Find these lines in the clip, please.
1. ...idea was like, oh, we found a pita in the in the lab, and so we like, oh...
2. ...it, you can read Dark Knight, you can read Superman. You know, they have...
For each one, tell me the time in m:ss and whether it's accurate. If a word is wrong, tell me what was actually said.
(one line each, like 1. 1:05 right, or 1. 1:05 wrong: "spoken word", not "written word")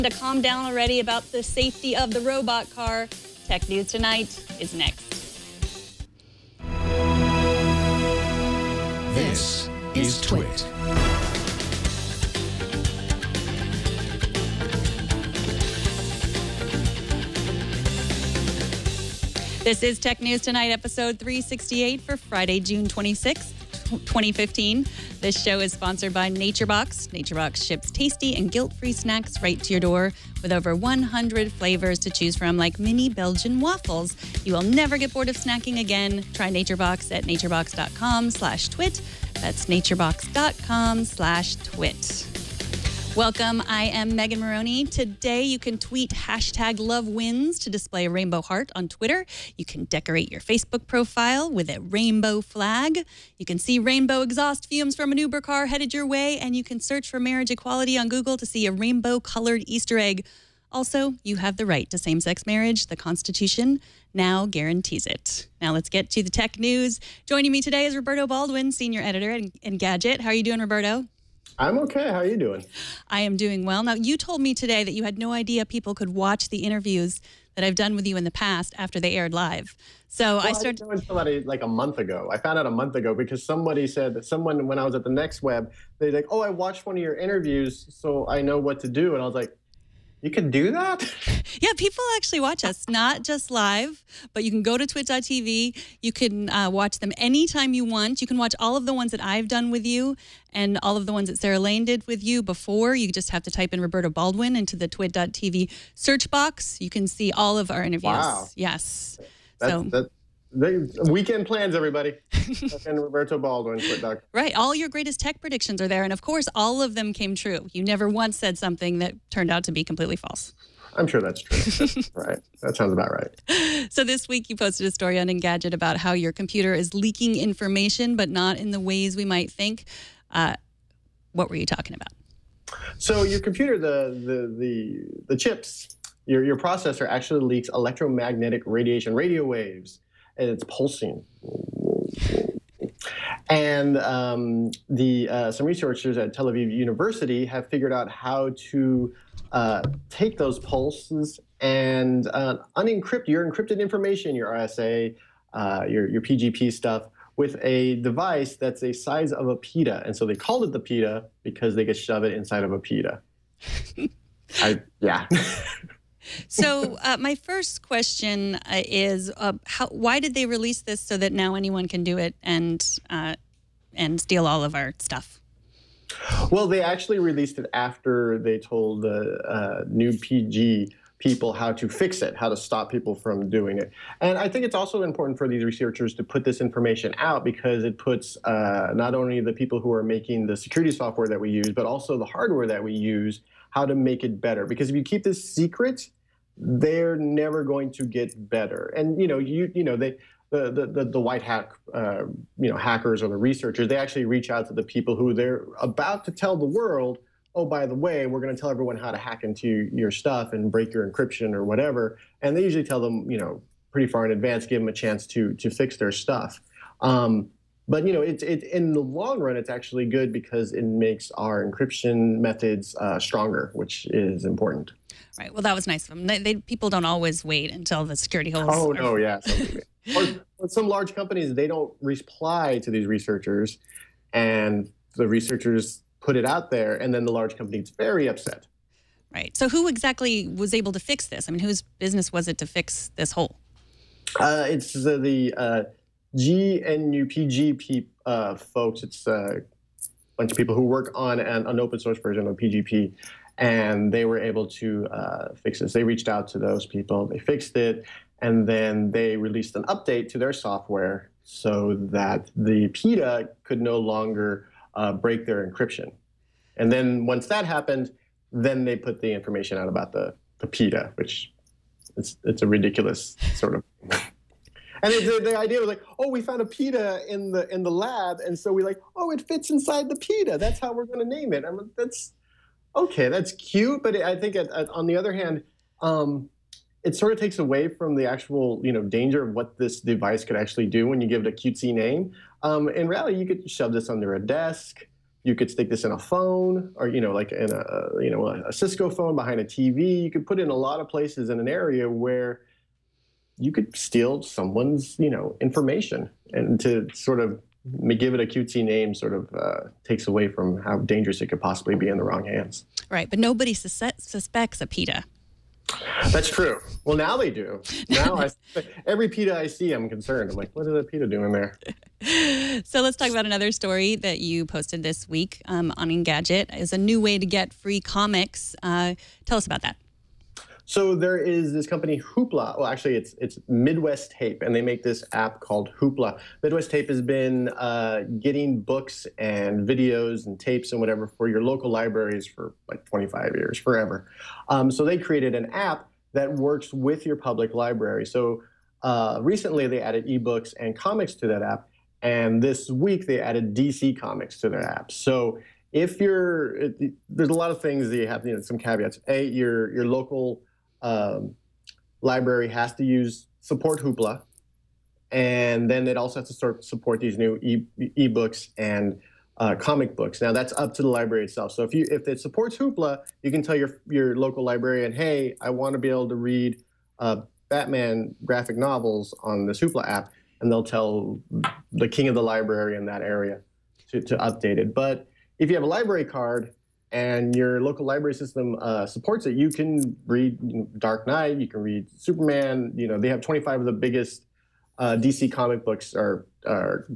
1. 4:35 right
2. 6:29 right.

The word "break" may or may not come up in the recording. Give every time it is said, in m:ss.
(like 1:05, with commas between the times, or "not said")
3:30, 4:25.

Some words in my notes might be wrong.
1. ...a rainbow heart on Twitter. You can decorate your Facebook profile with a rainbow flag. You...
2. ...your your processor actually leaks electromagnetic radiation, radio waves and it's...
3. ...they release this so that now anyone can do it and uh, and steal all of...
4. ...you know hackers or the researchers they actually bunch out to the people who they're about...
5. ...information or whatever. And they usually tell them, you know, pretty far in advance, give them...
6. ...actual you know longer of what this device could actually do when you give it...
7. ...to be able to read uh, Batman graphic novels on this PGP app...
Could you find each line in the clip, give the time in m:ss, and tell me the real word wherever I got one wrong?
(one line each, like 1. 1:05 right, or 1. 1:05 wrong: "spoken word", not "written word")
1. 0:48 right
2. 2:16 right
3. 2:50 right
4. 3:22 wrong: "reach", not "bunch"
5. 3:31 wrong: "encryption", not "information"
6. 4:48 wrong: "danger", not "longer"
7. 6:15 wrong: "Hoopla", not "PGP".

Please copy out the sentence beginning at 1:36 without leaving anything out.
You can uh, watch them anytime you want.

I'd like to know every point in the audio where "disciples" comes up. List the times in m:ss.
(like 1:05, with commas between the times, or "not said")
not said.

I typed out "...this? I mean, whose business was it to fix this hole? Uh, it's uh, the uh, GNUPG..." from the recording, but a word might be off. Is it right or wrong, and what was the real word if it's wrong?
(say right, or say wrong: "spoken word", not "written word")
right.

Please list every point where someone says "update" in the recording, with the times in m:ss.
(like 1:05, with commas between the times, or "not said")
4:19, 6:24.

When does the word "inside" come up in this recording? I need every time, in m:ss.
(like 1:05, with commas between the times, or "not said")
2:42, 4:39.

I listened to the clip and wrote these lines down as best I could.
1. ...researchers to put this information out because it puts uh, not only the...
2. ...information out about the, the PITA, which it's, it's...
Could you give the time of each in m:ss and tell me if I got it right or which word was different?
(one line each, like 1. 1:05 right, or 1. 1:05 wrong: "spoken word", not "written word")
1. 3:05 right
2. 4:29 right.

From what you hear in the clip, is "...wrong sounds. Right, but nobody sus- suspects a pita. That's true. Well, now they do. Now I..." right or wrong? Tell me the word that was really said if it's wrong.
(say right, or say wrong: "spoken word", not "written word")
wrong: "hands", not "sounds".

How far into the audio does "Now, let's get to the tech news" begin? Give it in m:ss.
1:05.